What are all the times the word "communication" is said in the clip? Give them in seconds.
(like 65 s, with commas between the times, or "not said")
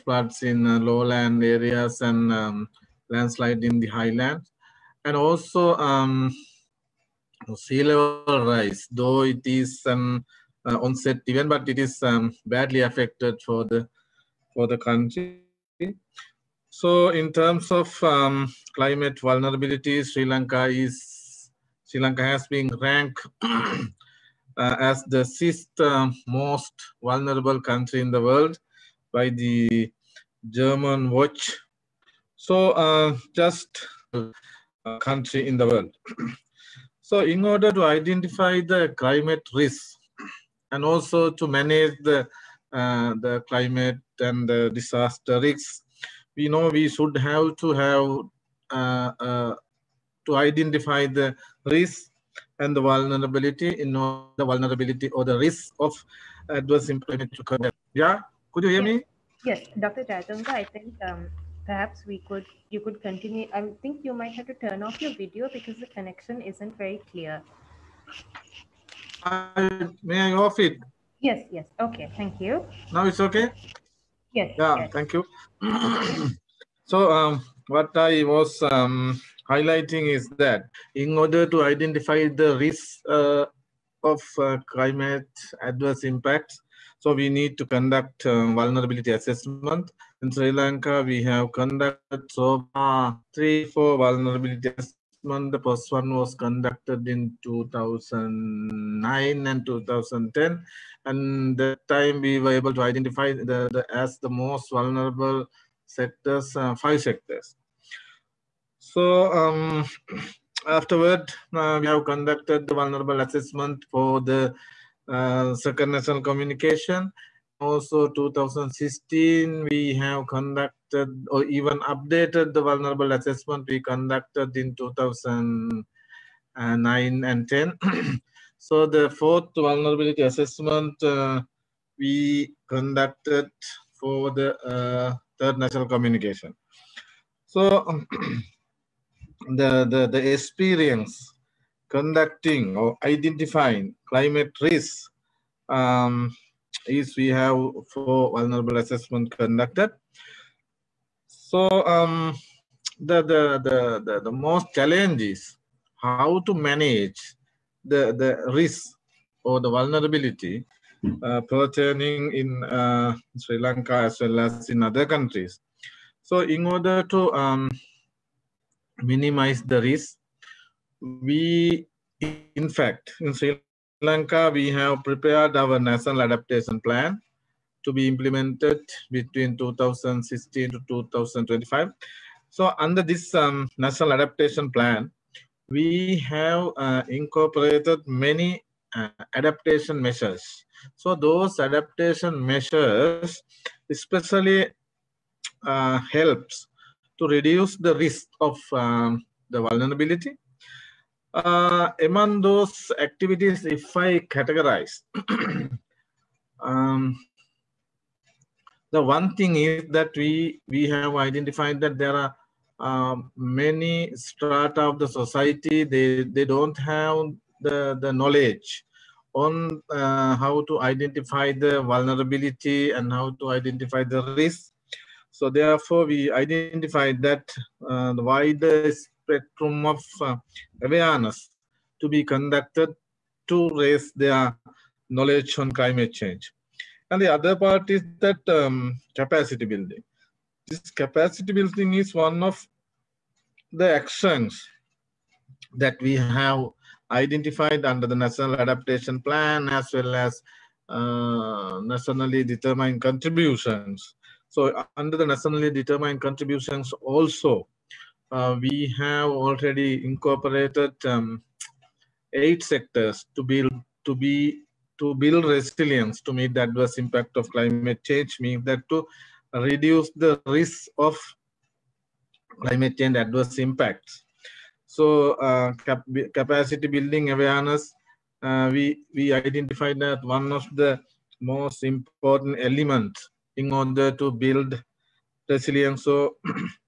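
116 s, 135 s.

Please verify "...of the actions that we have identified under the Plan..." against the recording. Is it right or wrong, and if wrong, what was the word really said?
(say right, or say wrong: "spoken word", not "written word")
wrong: "National", not "Plan".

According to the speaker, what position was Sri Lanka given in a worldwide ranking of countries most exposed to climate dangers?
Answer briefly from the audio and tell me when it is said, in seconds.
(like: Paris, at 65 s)
6th, at 25 s.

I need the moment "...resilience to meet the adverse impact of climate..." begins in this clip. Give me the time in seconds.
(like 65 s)
265 s.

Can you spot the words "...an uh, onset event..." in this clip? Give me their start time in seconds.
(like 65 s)
9 s.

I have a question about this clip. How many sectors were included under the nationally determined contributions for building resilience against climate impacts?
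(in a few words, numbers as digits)
8.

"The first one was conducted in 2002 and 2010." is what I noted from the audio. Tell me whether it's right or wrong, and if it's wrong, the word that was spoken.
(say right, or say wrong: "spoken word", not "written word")
wrong: "2009", not "2002".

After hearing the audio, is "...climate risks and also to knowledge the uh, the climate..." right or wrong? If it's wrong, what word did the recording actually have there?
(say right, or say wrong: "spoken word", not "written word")
wrong: "manage", not "knowledge".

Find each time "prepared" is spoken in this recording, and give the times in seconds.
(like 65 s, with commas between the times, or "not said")
175 s.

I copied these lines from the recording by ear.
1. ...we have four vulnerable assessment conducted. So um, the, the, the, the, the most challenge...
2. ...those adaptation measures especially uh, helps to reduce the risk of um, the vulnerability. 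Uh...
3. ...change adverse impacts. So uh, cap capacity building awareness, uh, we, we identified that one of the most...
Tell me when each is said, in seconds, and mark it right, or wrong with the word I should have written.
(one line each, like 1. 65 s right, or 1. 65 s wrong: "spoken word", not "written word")
1. 147 s right
2. 191 s right
3. 272 s right.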